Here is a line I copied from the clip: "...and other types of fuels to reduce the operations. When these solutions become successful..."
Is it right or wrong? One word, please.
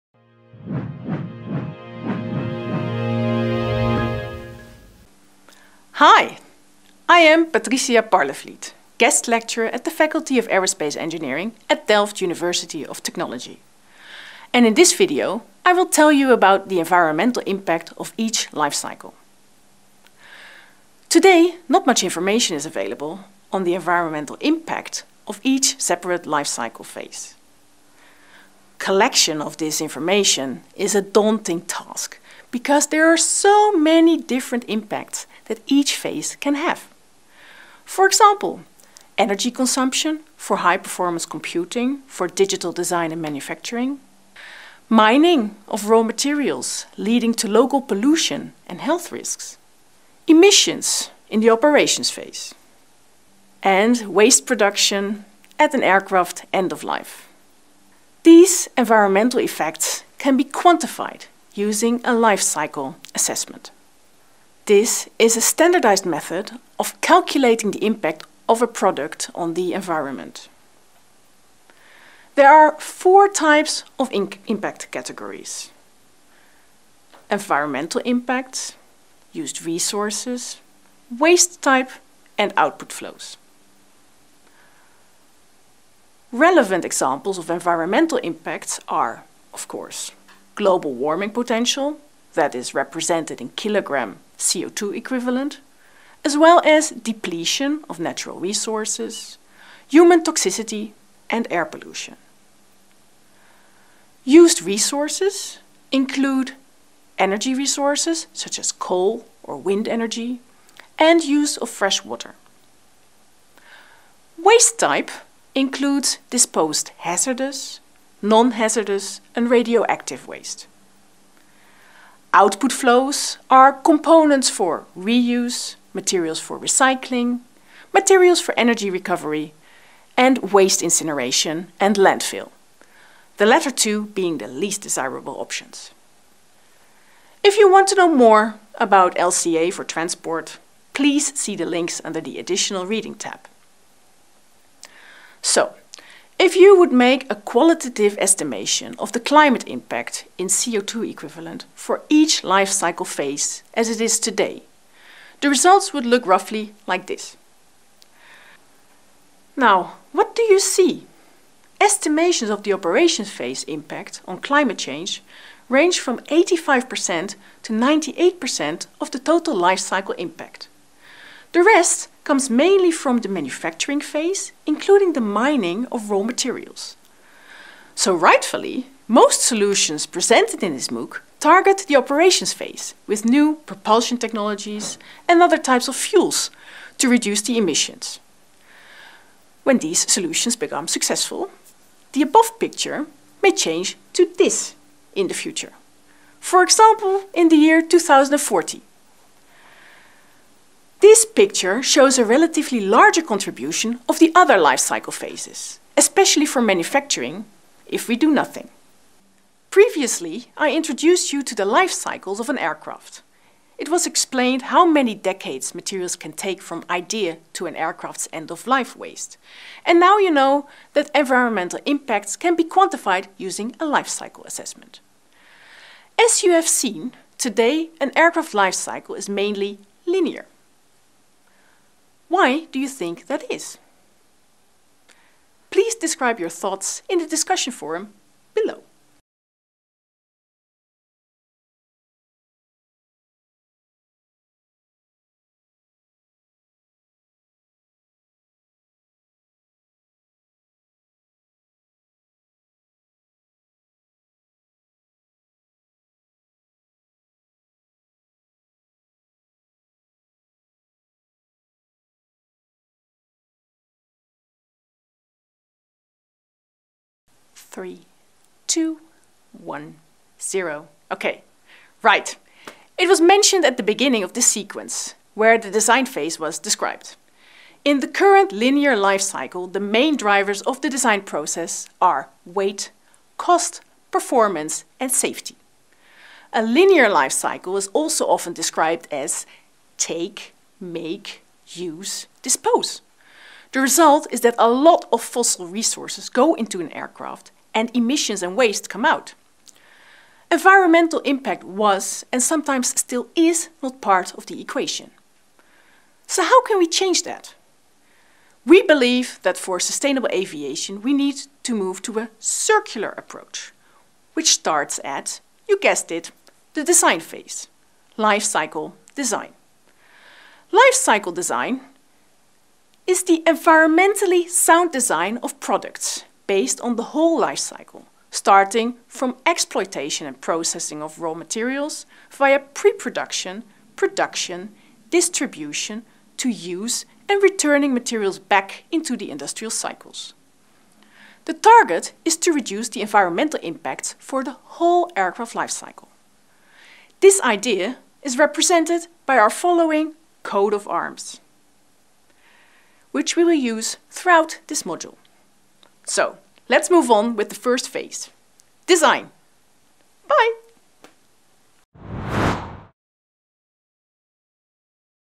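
wrong.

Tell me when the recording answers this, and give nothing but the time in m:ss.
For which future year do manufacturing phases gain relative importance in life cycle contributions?
3:17.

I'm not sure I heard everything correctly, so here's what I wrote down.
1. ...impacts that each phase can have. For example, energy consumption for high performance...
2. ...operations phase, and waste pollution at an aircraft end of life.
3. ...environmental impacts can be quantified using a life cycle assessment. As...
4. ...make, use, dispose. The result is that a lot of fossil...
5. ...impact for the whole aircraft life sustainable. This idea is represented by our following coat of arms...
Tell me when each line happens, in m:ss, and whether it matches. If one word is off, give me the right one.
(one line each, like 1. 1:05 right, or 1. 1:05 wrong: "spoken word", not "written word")
1. 0:34 right
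2. 0:51 wrong: "production", not "pollution"
3. 3:41 right
4. 4:50 right
5. 5:43 wrong: "cycle", not "sustainable".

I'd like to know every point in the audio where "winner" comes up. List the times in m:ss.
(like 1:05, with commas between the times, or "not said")
not said.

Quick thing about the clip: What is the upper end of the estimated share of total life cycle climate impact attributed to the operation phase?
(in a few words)
98%.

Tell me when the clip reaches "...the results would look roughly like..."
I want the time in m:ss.
2:35.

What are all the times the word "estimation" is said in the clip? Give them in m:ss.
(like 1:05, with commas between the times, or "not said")
2:28, 2:41.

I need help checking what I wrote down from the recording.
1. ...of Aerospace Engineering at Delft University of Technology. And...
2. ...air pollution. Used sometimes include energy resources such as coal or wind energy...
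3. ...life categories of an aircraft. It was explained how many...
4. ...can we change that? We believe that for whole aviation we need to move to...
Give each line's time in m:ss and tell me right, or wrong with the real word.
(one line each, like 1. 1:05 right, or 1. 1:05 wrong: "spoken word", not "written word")
1. 0:10 right
2. 1:41 wrong: "resources", not "sometimes"
3. 3:31 wrong: "cycles", not "categories"
4. 5:06 wrong: "sustainable", not "whole".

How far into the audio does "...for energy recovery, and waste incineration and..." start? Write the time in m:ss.
2:08.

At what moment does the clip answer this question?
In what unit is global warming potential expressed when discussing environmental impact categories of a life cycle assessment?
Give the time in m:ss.
1:33.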